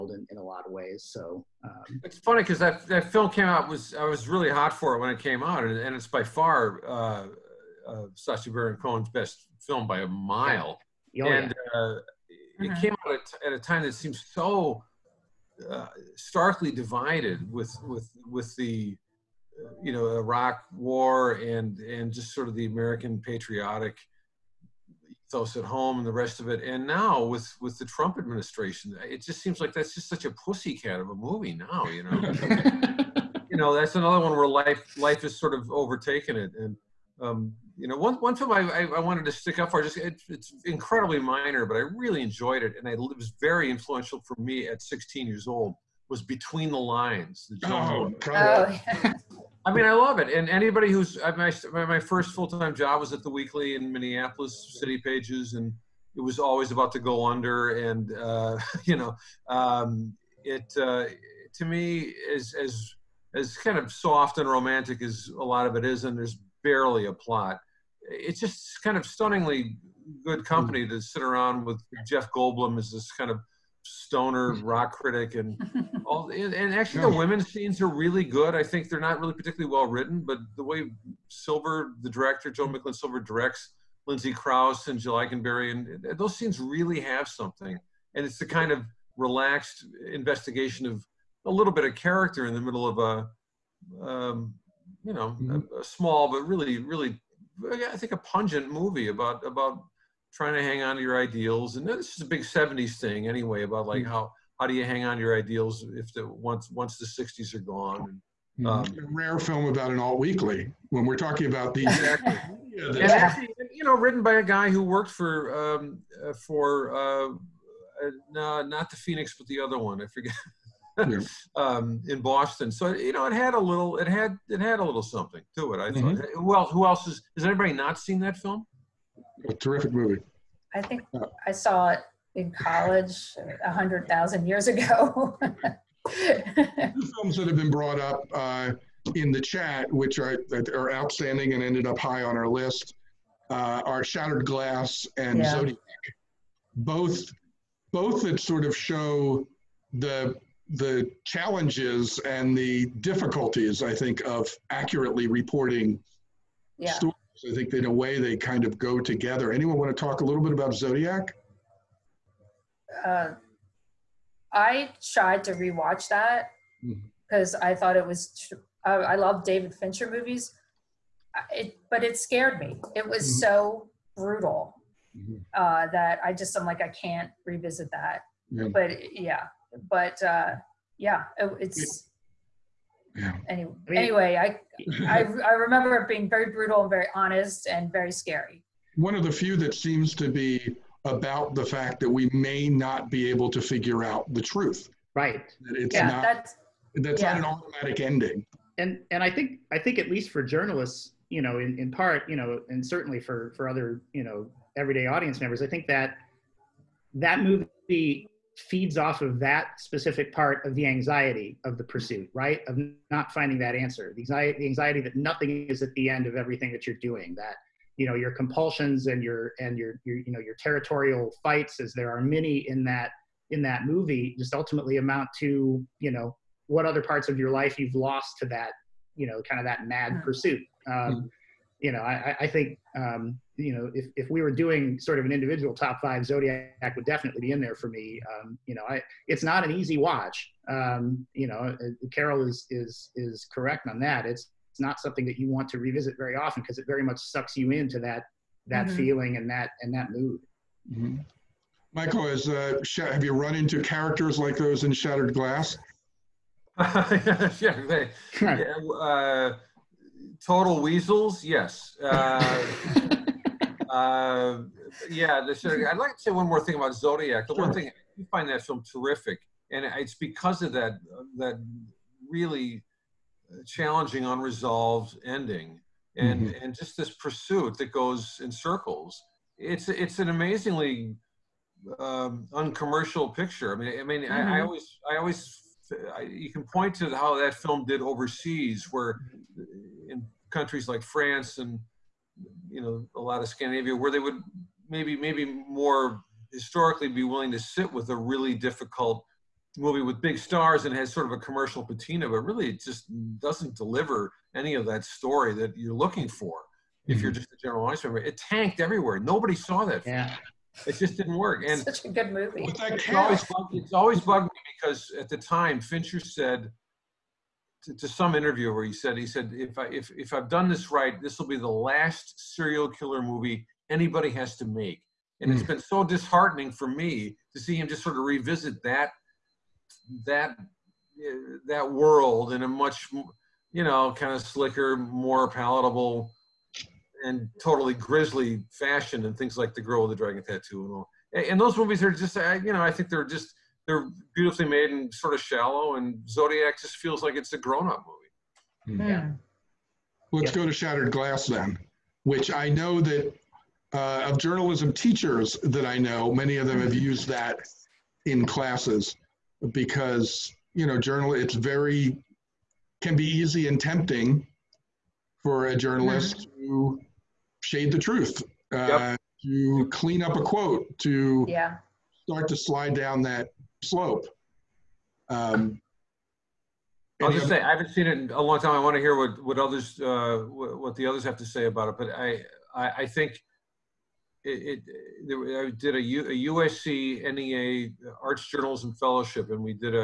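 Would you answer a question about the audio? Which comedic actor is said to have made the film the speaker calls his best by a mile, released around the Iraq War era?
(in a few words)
Sacha Baron Cohen.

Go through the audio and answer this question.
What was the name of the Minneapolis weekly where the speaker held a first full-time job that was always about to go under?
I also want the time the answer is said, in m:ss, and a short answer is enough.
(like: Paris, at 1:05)
City Pages, at 0:54.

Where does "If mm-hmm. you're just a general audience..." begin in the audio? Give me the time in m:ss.
5:07.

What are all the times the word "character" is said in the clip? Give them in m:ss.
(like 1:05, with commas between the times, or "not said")
1:31, 4:13.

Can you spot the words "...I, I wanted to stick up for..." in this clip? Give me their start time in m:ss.
0:38.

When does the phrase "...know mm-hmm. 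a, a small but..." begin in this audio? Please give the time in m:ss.
1:35.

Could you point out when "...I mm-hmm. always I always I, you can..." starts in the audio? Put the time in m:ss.
4:44.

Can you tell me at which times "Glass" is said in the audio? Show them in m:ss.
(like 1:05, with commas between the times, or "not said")
2:24, 4:15, 5:51.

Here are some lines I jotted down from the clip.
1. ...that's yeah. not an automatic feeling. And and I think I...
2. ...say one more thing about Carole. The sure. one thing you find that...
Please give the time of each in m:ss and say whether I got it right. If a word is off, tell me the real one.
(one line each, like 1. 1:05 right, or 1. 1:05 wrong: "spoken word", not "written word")
1. 3:16 wrong: "ending", not "feeling"
2. 4:26 wrong: "Zodiac", not "Carole".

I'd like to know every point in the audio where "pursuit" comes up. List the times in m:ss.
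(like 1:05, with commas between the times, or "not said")
3:31, 3:50, 4:37.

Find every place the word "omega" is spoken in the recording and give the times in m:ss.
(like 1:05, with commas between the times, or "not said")
not said.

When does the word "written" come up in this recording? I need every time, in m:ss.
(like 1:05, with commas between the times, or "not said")
1:19, 1:53.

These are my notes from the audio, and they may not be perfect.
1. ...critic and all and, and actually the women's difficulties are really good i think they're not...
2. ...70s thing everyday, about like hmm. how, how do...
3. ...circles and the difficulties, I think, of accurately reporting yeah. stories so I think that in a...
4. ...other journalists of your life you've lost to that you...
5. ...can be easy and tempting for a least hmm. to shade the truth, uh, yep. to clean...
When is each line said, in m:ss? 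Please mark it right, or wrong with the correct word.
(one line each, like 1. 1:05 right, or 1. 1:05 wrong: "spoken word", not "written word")
1. 1:14 wrong: "scenes", not "difficulties"
2. 1:42 wrong: "anyway", not "everyday"
3. 2:31 wrong: "challenges", not "circles"
4. 3:46 wrong: "parts", not "journalists"
5. 6:03 wrong: "journalist", not "least".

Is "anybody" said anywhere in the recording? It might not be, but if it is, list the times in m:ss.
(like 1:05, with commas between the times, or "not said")
0:50, 2:07, 5:23.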